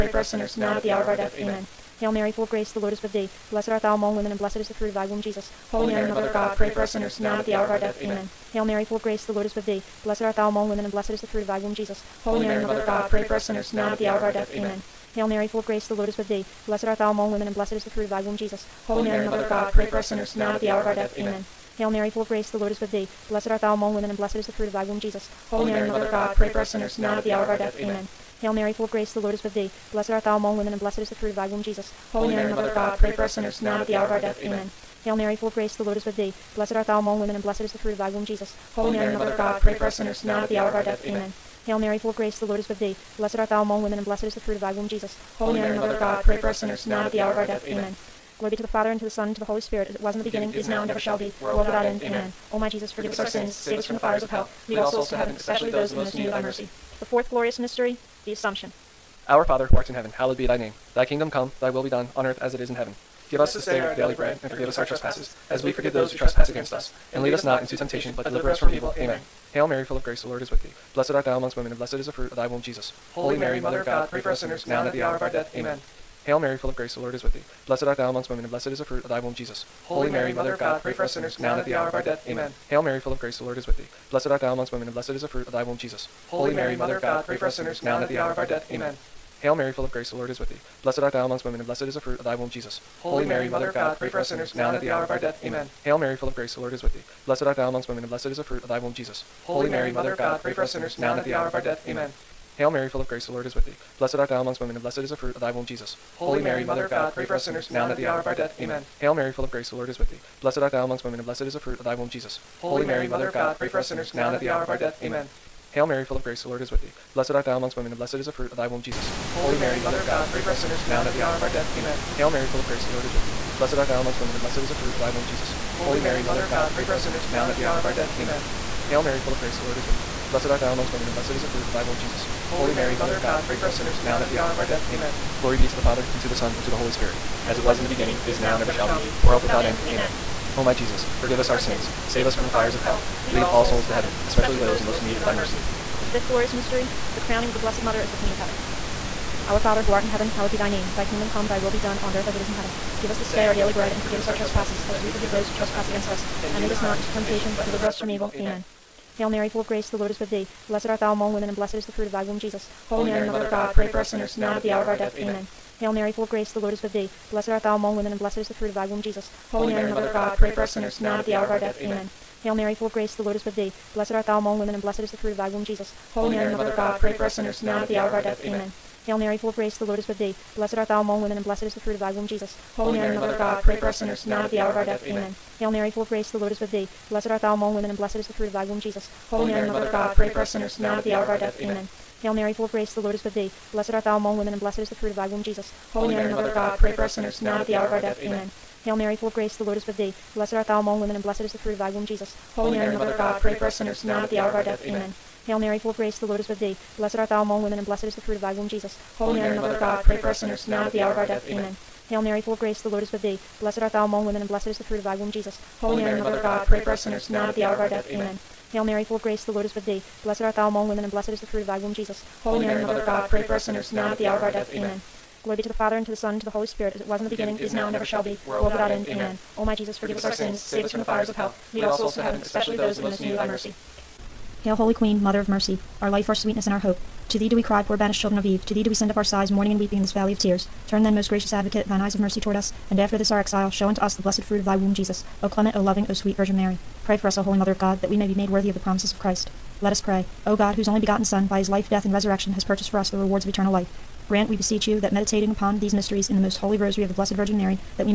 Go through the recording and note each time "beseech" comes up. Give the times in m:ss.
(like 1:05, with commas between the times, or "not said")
4:14.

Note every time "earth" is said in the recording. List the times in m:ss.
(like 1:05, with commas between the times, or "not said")
1:02, 2:32.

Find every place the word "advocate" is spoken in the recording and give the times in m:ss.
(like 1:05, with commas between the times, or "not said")
4:01.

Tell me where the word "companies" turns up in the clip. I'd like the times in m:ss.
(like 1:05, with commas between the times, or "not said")
not said.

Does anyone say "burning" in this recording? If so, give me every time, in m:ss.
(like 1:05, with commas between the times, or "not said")
not said.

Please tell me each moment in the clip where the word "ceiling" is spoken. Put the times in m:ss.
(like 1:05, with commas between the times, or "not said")
not said.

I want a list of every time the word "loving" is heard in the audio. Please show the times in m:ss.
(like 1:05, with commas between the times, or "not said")
4:05.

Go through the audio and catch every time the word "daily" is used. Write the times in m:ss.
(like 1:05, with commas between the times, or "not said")
1:03, 2:33.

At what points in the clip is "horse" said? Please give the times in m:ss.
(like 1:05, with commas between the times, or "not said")
not said.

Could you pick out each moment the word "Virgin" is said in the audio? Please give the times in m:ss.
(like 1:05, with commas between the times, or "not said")
4:06, 4:17.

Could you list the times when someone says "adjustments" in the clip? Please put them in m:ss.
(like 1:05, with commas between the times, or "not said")
not said.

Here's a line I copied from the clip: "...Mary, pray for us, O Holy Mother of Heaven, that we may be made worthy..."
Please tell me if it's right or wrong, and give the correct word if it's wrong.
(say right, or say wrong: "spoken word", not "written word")
wrong: "God", not "Heaven".